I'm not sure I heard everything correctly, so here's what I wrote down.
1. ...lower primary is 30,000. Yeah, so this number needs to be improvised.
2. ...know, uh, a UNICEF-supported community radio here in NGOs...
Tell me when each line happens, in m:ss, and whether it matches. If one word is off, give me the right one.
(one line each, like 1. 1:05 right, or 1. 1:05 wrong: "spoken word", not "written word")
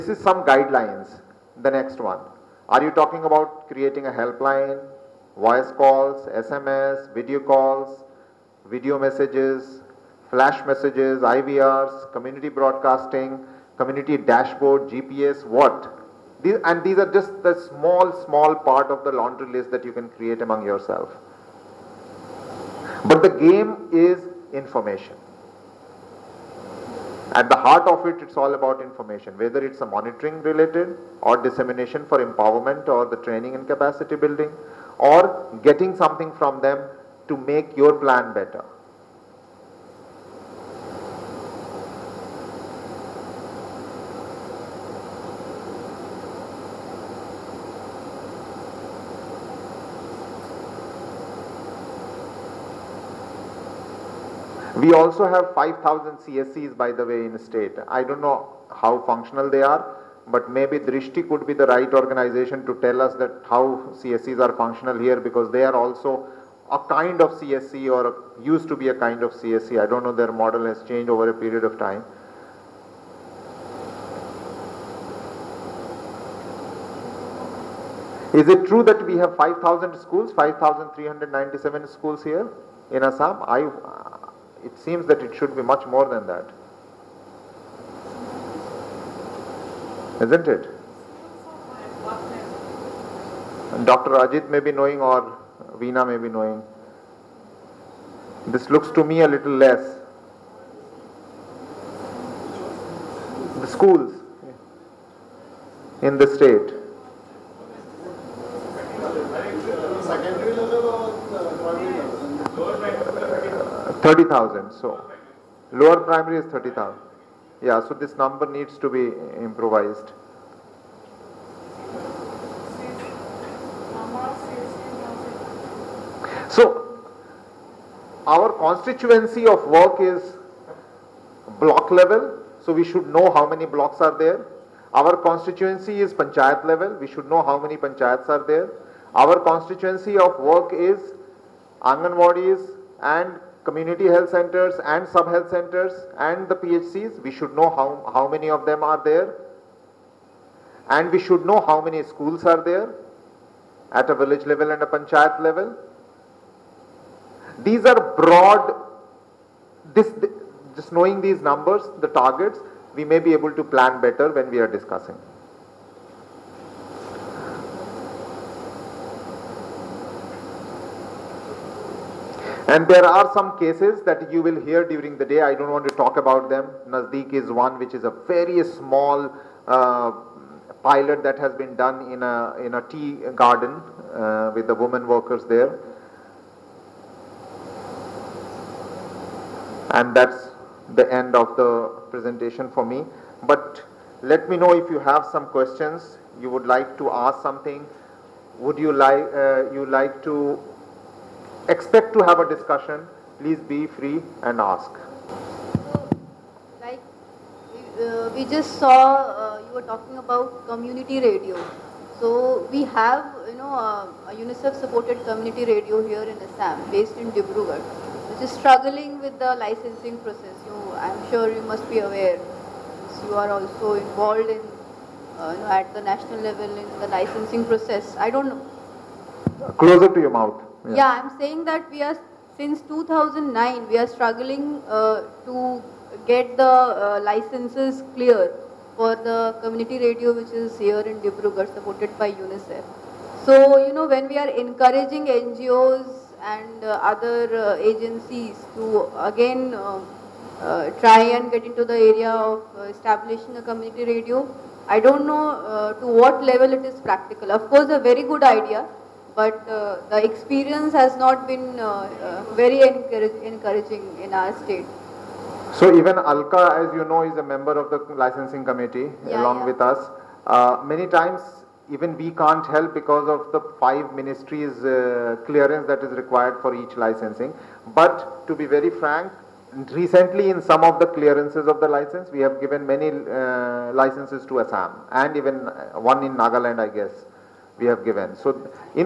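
1. 1:55 right
2. 3:33 wrong: "Assam", not "NGOs".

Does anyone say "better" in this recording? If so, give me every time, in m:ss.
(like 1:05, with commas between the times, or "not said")
0:38, 2:44.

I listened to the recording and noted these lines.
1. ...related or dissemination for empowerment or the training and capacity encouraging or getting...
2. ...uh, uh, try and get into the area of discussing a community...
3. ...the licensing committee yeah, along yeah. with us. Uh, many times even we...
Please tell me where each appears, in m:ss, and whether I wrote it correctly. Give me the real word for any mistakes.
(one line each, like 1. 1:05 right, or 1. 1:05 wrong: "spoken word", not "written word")
1. 0:30 wrong: "building", not "encouraging"
2. 4:09 wrong: "establishing", not "discussing"
3. 4:27 right.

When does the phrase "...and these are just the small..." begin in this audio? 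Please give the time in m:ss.
0:16.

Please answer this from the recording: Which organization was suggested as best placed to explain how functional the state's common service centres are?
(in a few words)
Drishtee.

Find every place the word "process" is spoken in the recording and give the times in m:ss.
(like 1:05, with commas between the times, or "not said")
3:40, 3:47.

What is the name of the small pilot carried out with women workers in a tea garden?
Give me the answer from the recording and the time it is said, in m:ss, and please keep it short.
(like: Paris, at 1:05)
Nazdeek, at 2:56.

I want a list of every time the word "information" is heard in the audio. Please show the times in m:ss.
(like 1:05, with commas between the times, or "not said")
0:24, 0:28.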